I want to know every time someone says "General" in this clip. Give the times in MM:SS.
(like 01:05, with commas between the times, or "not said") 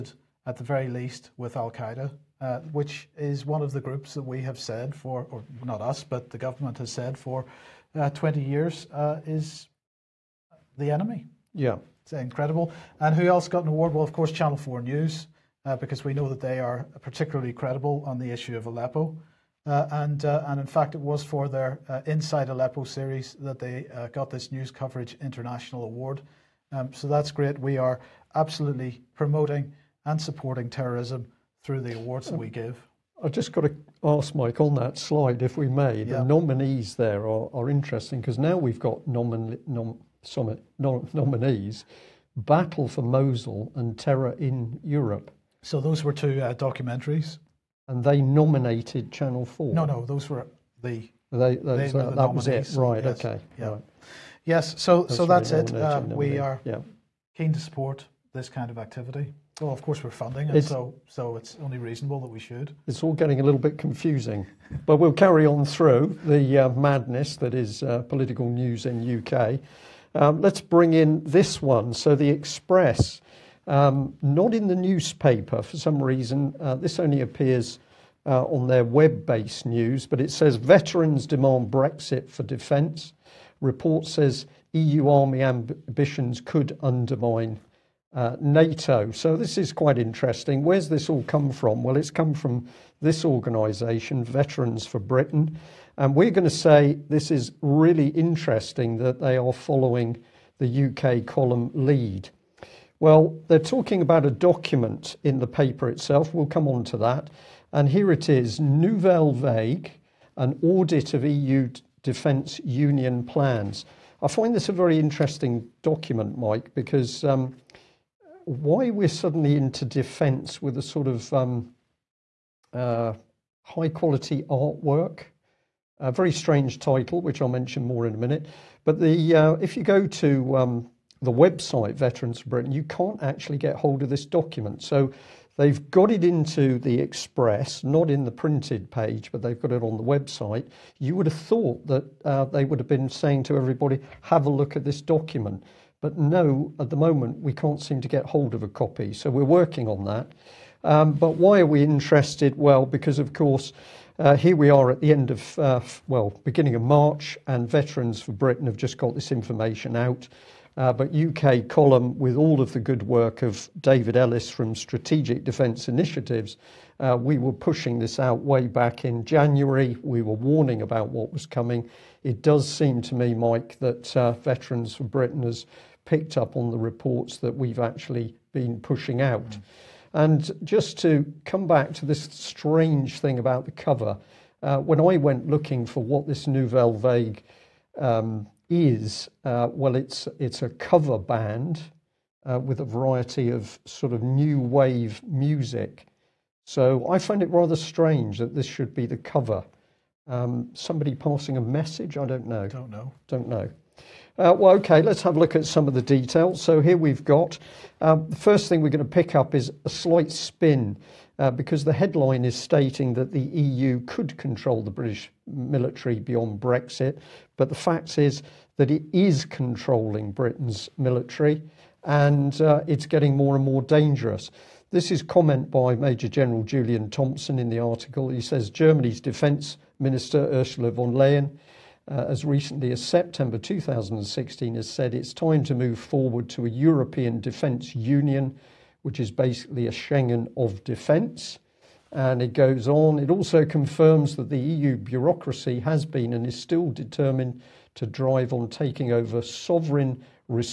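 03:46.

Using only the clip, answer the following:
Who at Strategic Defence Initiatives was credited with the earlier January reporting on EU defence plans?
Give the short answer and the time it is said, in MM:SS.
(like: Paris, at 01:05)
David Ellis, at 02:43.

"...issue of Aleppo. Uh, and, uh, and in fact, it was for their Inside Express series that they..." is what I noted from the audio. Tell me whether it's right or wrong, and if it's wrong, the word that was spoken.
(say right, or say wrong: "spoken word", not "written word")
wrong: "Aleppo", not "Express".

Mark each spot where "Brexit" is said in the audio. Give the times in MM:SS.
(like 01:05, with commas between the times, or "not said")
01:21, 03:36.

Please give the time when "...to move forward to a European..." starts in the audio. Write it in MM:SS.
03:55.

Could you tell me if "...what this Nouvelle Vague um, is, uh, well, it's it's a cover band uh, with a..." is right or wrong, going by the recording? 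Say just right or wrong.
right.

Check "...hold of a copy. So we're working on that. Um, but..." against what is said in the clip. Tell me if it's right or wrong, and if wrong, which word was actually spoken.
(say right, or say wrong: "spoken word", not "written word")
right.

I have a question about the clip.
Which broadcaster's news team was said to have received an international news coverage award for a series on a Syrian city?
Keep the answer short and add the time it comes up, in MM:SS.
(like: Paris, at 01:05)
Channel 4 News, at 00:14.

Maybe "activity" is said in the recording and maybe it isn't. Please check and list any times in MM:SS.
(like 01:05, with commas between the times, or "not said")
00:58.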